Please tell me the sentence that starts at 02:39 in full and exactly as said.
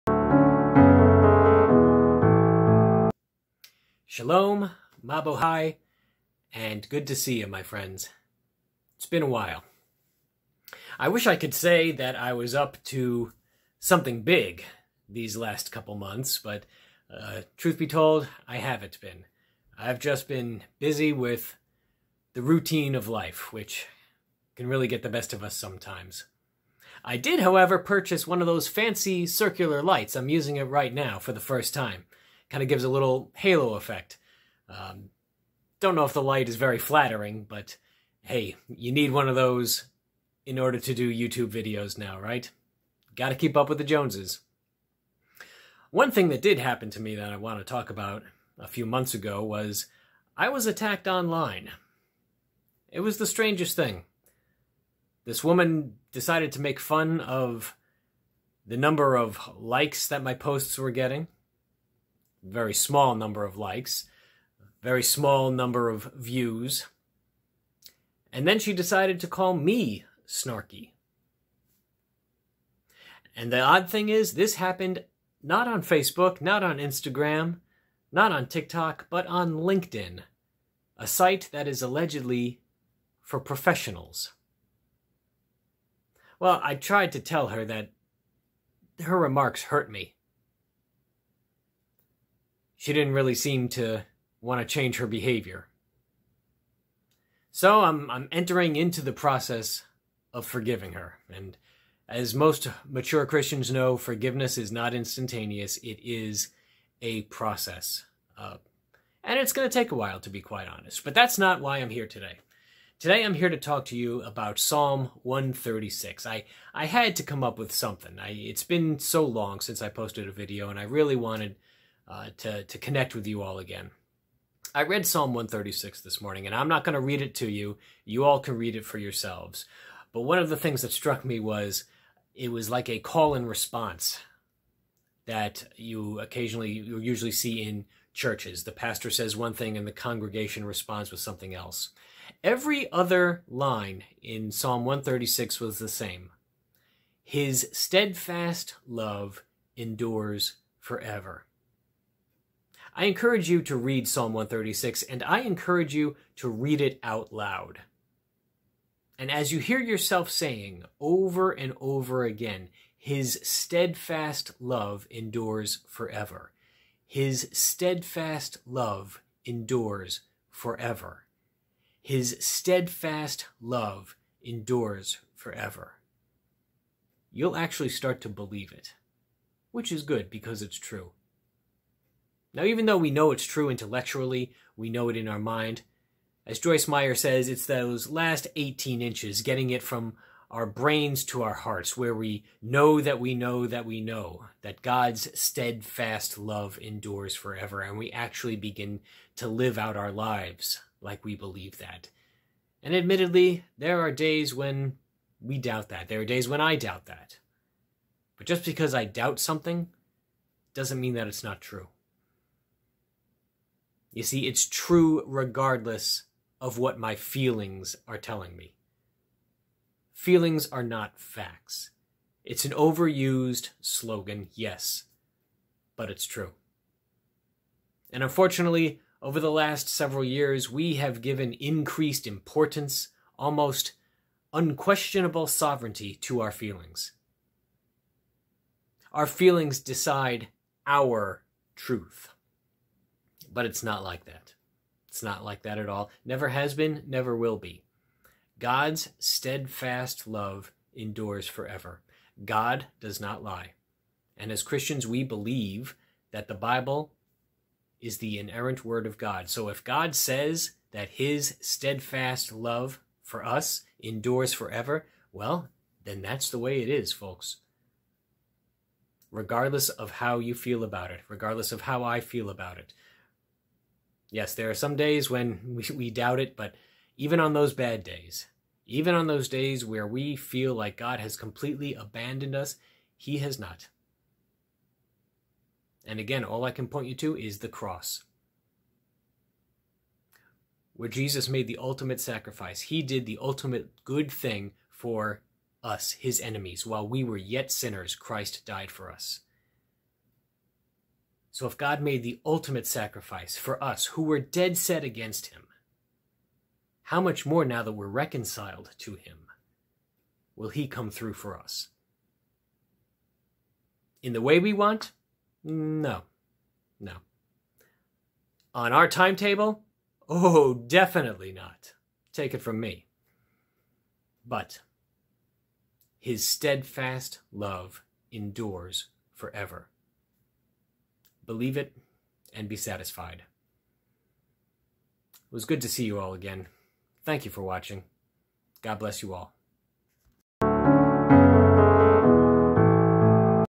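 And as you hear yourself saying over and over again, His steadfast love endures forever.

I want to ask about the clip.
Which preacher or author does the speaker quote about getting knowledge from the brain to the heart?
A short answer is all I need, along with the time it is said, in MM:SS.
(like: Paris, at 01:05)
Joyce Meyer, at 03:06.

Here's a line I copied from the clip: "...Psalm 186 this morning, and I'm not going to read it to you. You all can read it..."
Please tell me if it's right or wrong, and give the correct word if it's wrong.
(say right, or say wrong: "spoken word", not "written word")
wrong: "136", not "186".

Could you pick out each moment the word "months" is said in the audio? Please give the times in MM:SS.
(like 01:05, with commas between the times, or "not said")
00:15, 00:48.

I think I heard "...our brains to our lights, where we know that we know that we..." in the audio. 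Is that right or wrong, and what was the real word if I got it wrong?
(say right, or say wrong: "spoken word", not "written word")
wrong: "hearts", not "lights".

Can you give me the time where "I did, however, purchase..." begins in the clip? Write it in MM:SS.
00:27.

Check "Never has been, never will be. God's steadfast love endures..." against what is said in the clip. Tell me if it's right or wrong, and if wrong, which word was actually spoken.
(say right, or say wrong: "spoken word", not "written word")
right.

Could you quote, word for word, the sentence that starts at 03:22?
And admittedly, there are days when we doubt that.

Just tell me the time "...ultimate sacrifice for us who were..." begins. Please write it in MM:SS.
05:02.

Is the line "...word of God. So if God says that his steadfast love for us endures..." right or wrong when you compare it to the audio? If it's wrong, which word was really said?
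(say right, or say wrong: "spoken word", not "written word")
right.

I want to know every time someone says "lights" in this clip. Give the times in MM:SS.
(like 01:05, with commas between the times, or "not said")
00:29, 00:36.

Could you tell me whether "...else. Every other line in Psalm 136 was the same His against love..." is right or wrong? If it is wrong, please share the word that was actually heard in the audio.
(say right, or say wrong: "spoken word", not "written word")
wrong: "steadfast", not "against".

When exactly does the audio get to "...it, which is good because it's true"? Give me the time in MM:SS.
02:58.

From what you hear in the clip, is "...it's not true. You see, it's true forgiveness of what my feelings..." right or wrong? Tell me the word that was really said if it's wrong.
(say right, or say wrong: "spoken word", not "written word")
wrong: "regardless", not "forgiveness".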